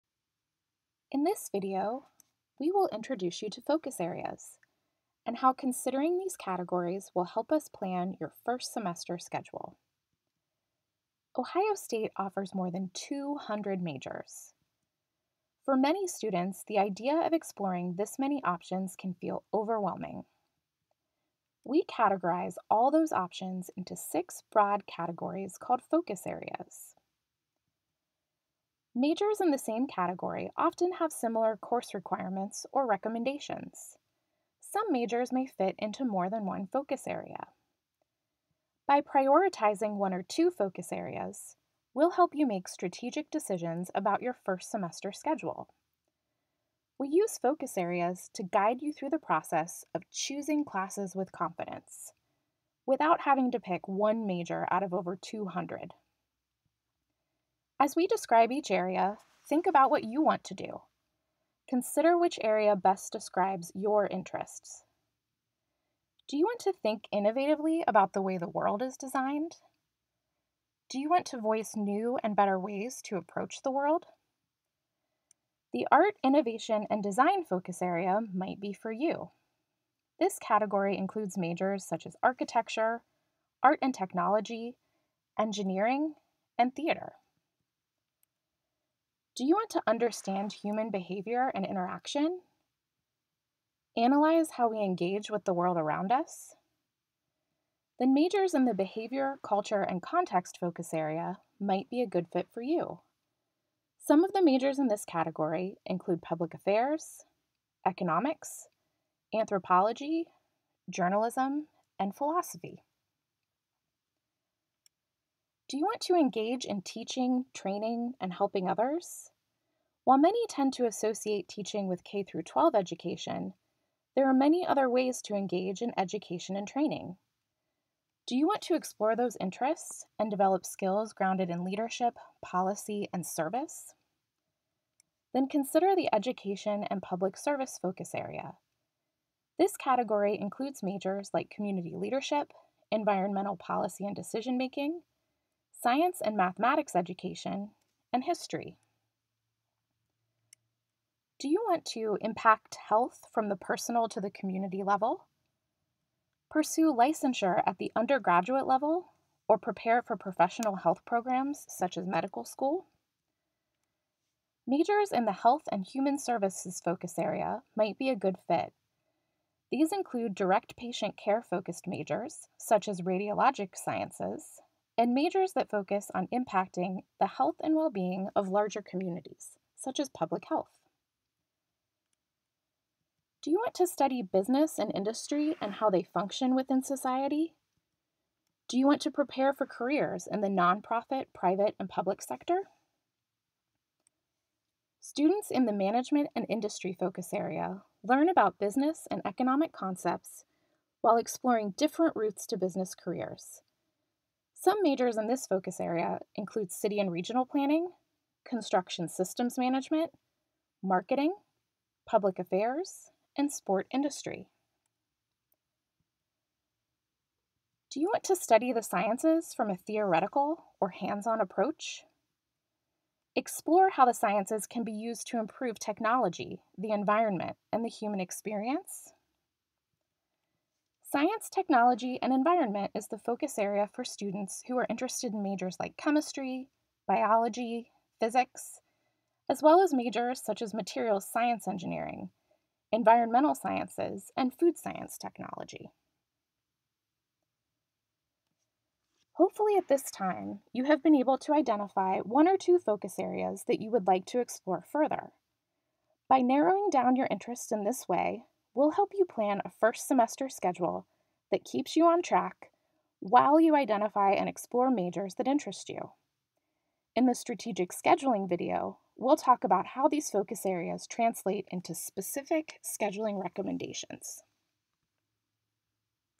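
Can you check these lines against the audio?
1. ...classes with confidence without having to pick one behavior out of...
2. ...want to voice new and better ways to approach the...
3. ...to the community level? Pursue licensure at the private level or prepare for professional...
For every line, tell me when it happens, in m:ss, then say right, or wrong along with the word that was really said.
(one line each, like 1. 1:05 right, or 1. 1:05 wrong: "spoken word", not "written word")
1. 0:50 wrong: "major", not "behavior"
2. 1:11 right
3. 2:34 wrong: "undergraduate", not "private".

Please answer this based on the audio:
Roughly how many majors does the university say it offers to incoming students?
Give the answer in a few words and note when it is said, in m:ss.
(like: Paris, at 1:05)
more than 200, at 0:12.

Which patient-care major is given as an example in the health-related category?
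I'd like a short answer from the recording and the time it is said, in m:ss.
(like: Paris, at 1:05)
radiologic sciences, at 2:53.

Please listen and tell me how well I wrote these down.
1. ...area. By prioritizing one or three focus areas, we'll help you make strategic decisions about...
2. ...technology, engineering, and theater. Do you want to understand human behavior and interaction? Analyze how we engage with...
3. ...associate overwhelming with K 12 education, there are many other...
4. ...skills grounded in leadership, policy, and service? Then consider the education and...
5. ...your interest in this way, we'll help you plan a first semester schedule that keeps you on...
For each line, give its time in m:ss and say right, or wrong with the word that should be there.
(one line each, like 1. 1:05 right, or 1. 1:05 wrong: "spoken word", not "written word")
1. 0:37 wrong: "two", not "three"
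2. 1:23 right
3. 2:00 wrong: "teaching", not "overwhelming"
4. 2:10 right
5. 4:17 right.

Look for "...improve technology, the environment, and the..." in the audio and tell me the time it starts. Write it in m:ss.
3:45.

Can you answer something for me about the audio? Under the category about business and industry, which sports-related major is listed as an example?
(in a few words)
sport industry.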